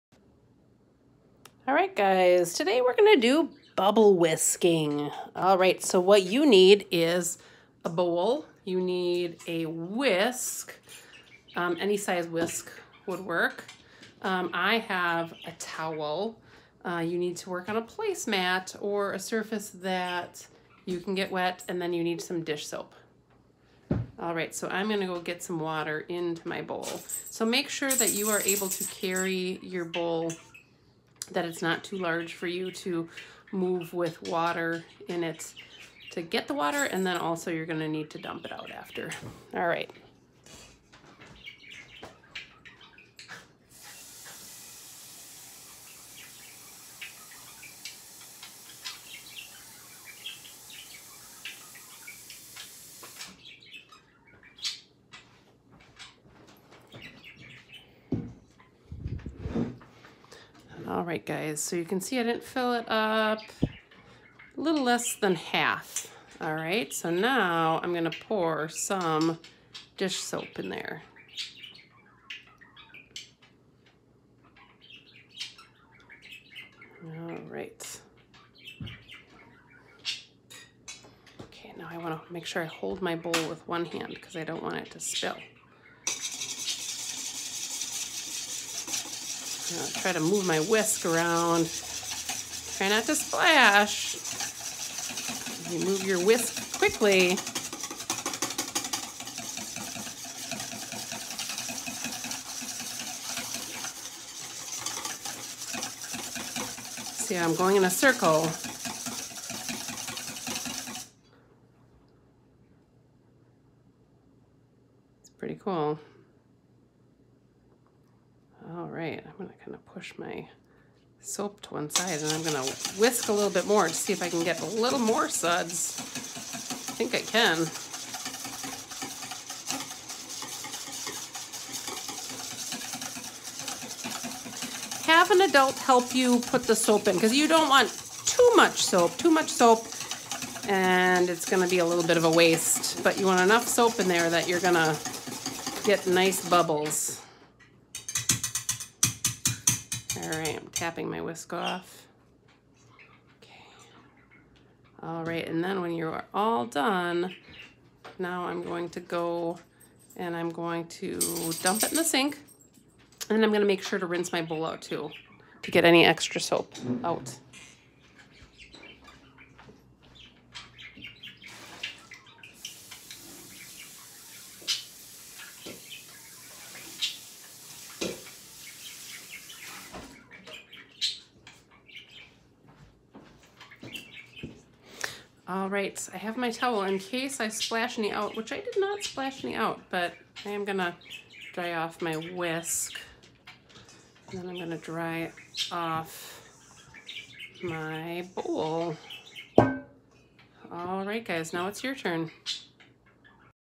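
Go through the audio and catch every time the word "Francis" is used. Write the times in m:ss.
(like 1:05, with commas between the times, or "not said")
not said.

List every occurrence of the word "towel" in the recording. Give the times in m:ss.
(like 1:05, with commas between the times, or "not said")
0:15, 3:06.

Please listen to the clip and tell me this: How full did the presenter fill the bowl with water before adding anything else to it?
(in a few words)
A little less than half.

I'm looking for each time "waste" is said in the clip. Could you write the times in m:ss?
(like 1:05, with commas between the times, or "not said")
2:22.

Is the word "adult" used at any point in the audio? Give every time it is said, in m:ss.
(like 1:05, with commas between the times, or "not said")
2:15.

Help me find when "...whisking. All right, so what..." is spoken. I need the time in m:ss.
0:04.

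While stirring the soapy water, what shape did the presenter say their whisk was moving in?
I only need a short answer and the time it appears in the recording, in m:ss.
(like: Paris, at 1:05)
A circle, at 1:47.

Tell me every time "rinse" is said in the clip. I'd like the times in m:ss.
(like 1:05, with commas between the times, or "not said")
2:44.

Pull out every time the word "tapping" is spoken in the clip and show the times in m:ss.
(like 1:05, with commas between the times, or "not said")
2:30.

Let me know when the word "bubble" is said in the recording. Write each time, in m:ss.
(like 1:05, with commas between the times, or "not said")
0:03, 2:26.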